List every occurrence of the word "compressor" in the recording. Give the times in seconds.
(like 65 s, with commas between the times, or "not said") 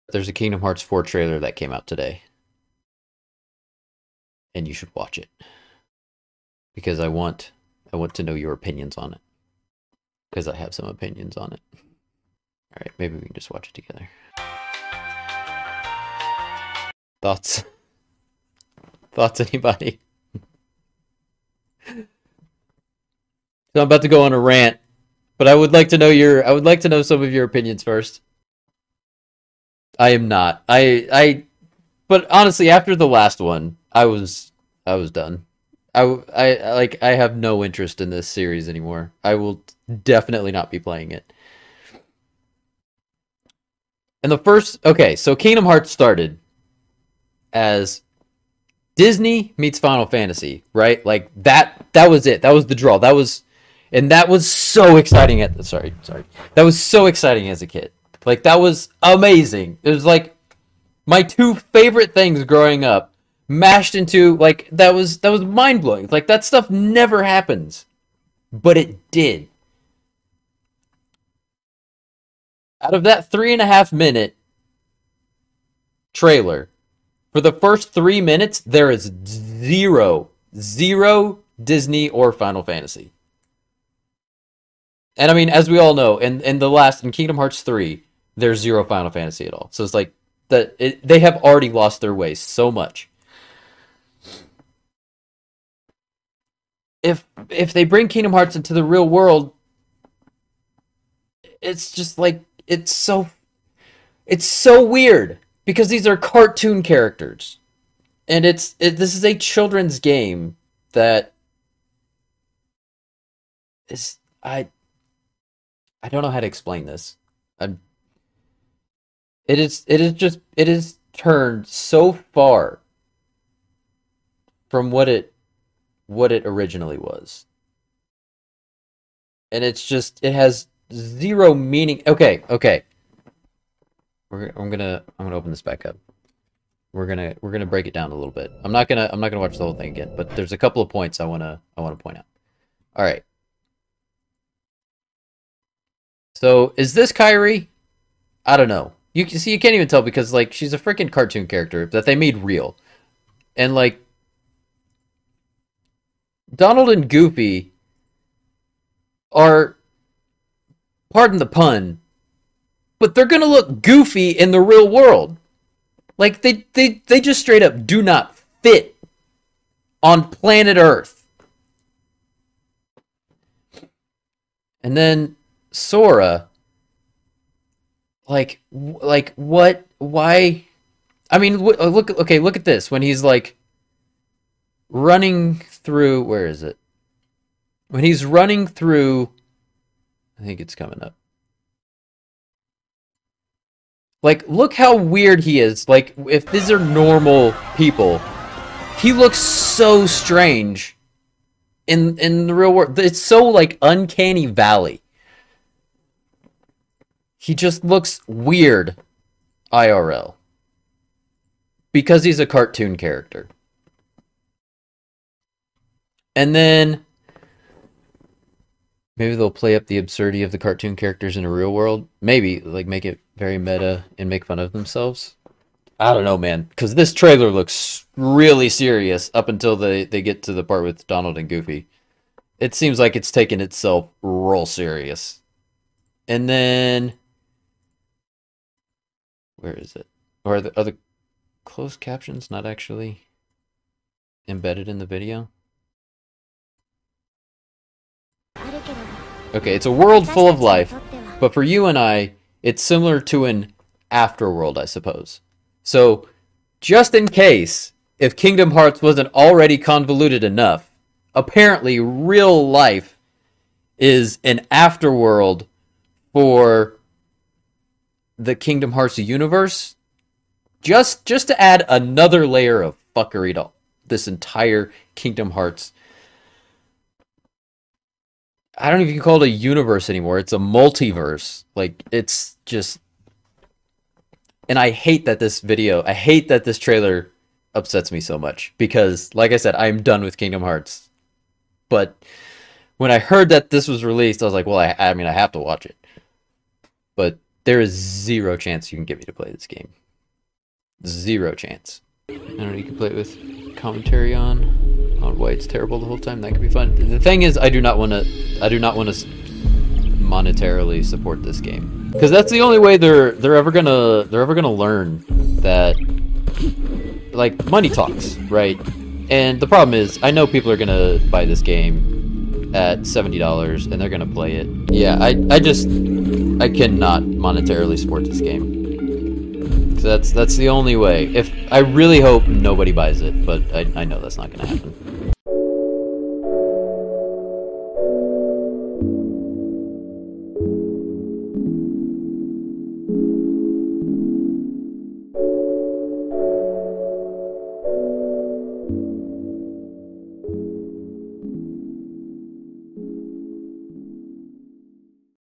not said.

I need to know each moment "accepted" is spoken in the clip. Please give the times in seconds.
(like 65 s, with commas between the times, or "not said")
not said.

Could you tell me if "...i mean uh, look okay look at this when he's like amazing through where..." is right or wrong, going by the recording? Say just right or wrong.
wrong.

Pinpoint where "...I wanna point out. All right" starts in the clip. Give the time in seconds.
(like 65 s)
141 s.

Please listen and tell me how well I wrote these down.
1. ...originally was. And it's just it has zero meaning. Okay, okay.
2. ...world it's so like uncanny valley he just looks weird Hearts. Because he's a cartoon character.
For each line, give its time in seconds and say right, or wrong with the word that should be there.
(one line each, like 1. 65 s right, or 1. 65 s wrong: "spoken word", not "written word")
1. 126 s right
2. 202 s wrong: "IRL", not "Hearts".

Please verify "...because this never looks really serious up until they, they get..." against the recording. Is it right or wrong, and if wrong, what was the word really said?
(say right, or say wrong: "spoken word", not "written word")
wrong: "trailer", not "never".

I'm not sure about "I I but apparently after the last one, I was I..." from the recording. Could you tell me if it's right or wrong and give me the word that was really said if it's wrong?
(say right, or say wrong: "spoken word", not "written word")
wrong: "honestly", not "apparently".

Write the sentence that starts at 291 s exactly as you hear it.
But when I heard that this was released, I was like, well, I, I mean, I have to watch it.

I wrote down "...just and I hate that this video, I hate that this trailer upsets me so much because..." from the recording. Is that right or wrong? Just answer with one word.
right.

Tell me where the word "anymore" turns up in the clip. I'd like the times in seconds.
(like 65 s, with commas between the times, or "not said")
38 s, 280 s.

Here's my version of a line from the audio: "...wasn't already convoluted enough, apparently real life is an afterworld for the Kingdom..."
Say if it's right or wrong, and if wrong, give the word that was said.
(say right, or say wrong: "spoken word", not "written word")
right.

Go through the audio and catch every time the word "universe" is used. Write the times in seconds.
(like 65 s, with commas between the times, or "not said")
269 s, 279 s.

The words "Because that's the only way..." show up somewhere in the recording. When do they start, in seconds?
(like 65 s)
312 s.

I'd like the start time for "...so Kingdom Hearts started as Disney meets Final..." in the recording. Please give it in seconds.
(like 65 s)
45 s.